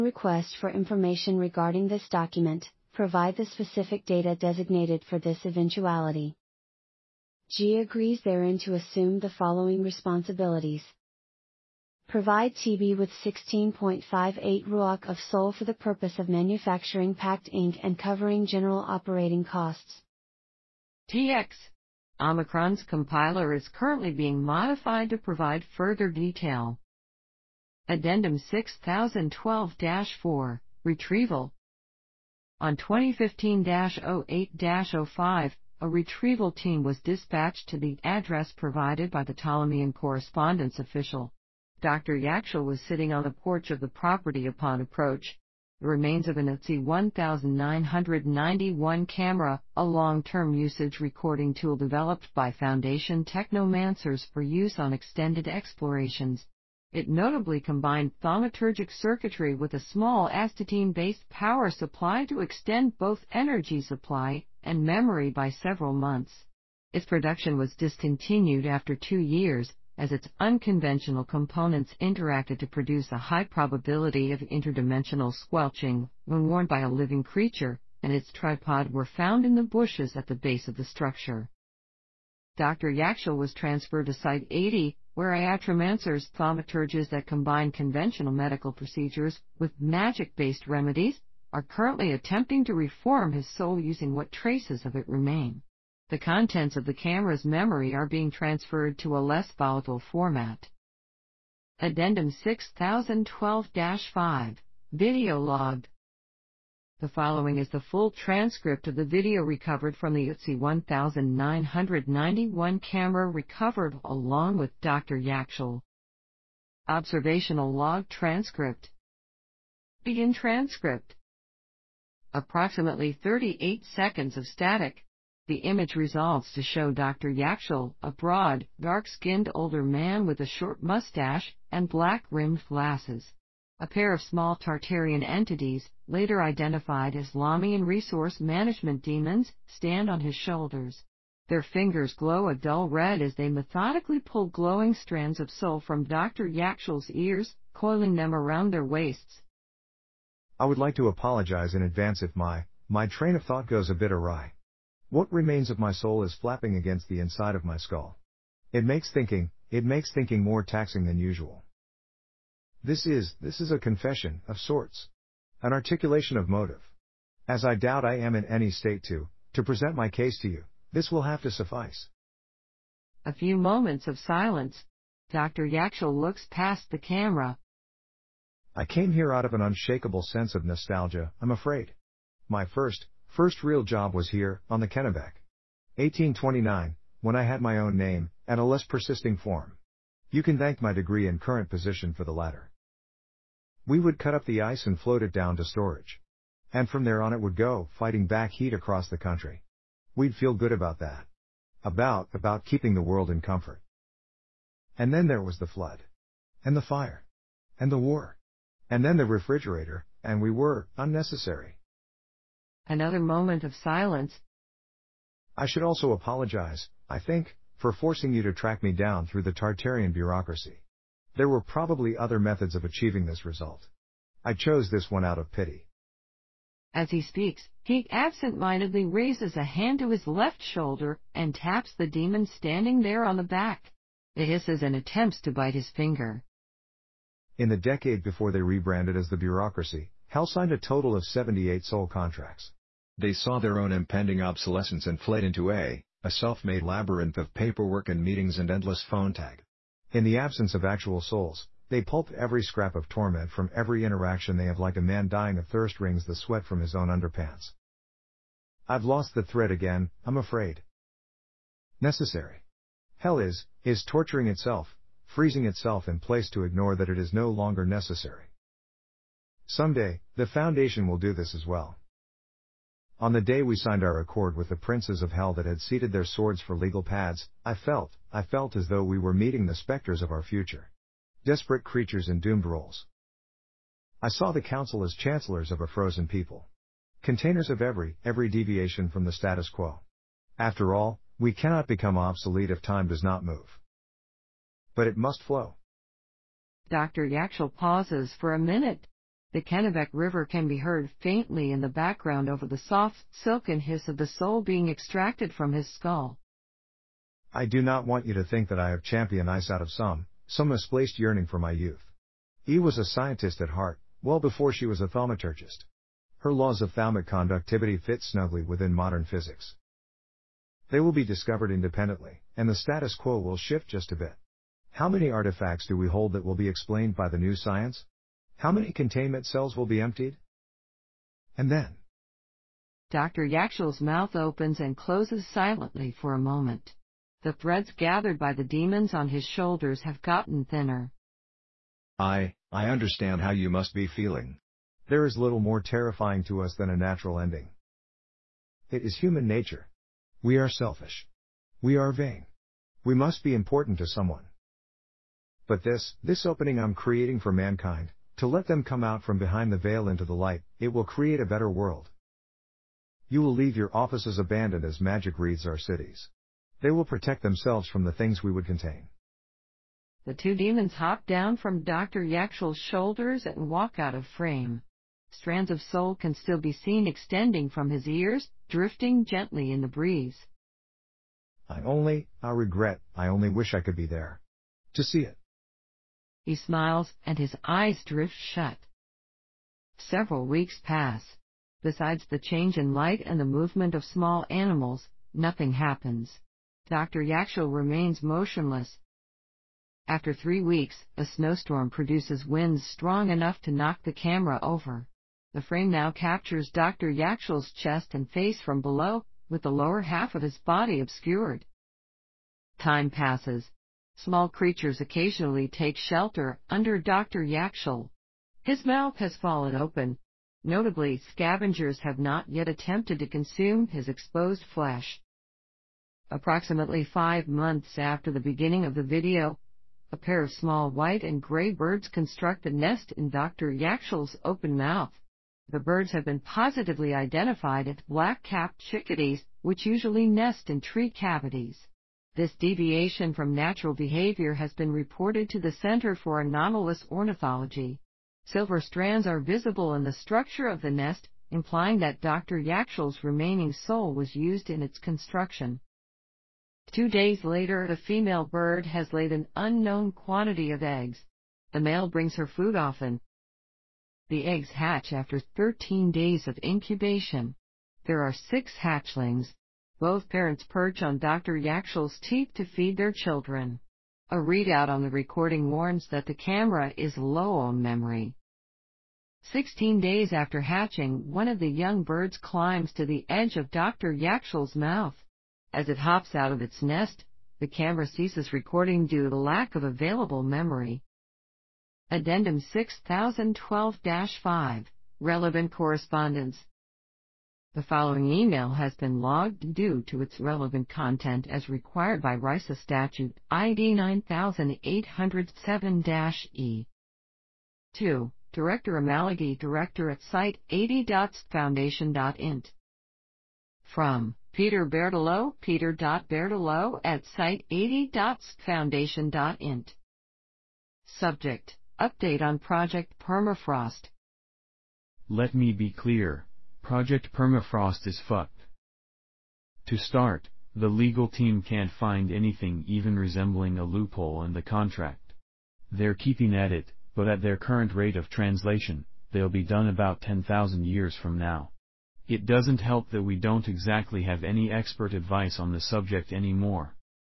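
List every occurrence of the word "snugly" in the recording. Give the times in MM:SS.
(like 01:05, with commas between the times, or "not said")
05:18.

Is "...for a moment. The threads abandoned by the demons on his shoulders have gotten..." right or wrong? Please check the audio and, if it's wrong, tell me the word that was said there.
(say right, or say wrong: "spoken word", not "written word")
wrong: "gathered", not "abandoned".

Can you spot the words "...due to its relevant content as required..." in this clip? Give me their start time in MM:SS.
08:19.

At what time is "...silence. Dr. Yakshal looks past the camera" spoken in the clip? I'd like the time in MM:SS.
02:54.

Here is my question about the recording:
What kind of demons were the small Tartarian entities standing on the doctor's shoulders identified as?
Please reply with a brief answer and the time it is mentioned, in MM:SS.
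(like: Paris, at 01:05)
Lamian resource management demons, at 02:17.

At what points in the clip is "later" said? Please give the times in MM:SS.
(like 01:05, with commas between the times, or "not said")
02:16, 07:37.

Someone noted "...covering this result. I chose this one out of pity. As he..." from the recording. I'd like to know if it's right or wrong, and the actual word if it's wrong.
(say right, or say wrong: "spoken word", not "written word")
wrong: "achieving", not "covering".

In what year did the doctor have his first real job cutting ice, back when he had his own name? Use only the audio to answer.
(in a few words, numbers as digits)
1829.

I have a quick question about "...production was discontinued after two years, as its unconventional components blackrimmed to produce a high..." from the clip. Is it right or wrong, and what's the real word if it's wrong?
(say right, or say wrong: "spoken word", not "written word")
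wrong: "interacted", not "blackrimmed".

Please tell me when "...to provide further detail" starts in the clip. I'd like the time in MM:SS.
00:25.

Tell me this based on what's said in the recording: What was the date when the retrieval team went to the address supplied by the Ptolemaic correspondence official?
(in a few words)
2015-08-05.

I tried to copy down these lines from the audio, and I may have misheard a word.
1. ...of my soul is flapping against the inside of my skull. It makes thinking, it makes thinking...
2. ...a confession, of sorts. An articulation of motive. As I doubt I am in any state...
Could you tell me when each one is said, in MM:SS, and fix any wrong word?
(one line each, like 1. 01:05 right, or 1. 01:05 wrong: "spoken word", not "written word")
1. 02:35 right
2. 02:43 right.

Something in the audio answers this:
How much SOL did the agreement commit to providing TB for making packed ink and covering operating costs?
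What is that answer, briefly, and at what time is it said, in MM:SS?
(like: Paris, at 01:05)
16.58 ruach, at 00:13.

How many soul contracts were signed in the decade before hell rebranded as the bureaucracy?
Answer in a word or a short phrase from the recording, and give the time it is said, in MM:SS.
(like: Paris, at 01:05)
78, at 04:01.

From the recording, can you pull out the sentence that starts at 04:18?
I've lost the thread again, I'm afraid.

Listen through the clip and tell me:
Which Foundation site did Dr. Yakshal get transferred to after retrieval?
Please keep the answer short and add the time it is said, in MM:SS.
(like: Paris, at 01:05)
Site 80, at 01:24.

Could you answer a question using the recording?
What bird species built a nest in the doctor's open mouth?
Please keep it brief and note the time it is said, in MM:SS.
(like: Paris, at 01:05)
black-capped chickadees, at 07:18.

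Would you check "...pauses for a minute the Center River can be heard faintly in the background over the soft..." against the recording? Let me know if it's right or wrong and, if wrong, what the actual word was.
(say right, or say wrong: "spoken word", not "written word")
wrong: "Kennebec", not "Center".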